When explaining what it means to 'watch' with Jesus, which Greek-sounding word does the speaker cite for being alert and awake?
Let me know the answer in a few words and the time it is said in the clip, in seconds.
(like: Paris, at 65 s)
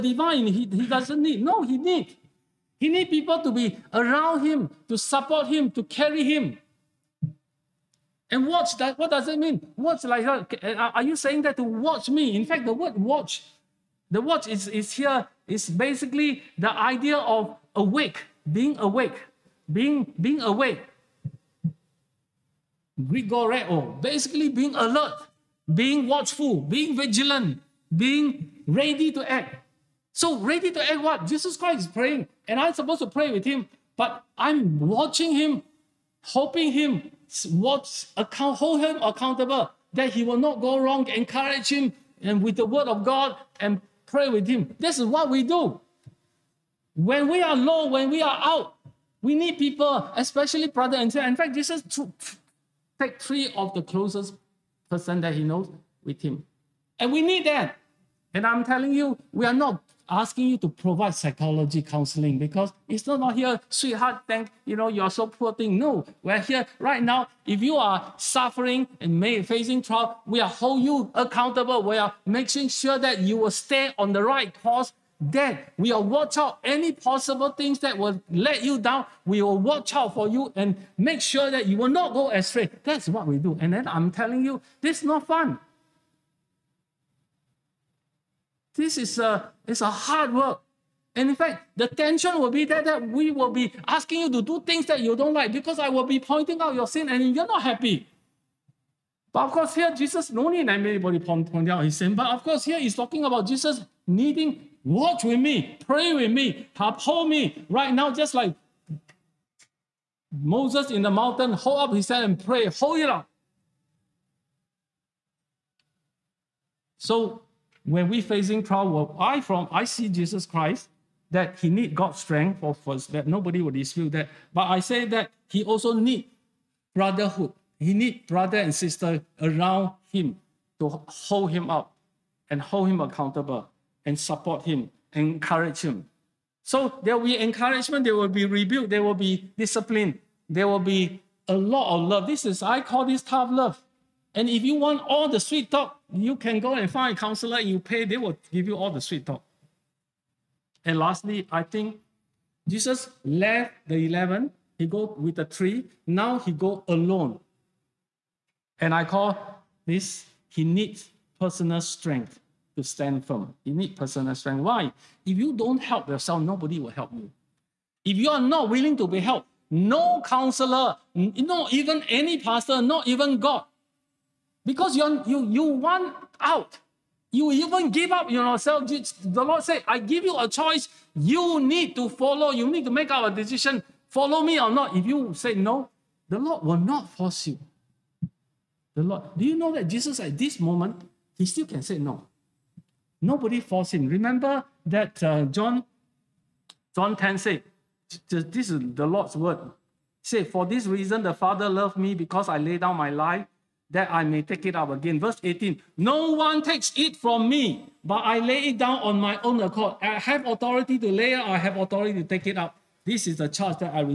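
Grigoreo, at 22 s.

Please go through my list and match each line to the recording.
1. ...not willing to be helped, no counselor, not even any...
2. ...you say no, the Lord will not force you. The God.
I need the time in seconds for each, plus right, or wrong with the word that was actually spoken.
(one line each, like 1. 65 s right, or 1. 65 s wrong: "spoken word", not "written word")
1. 168 s right
2. 185 s wrong: "Lord", not "God".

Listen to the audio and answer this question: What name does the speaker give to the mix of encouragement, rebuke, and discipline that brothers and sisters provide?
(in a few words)
tough love.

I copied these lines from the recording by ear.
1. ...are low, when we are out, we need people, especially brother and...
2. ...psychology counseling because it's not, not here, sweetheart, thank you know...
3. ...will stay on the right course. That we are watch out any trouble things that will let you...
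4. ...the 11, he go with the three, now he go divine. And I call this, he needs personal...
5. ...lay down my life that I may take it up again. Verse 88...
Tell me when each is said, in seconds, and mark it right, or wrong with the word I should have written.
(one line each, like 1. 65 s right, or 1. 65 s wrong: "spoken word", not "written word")
1. 47 s right
2. 61 s right
3. 73 s wrong: "possible", not "trouble"
4. 153 s wrong: "alone", not "divine"
5. 202 s wrong: "18", not "88".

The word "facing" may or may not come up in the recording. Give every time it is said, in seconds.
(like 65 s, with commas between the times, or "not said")
69 s, 118 s.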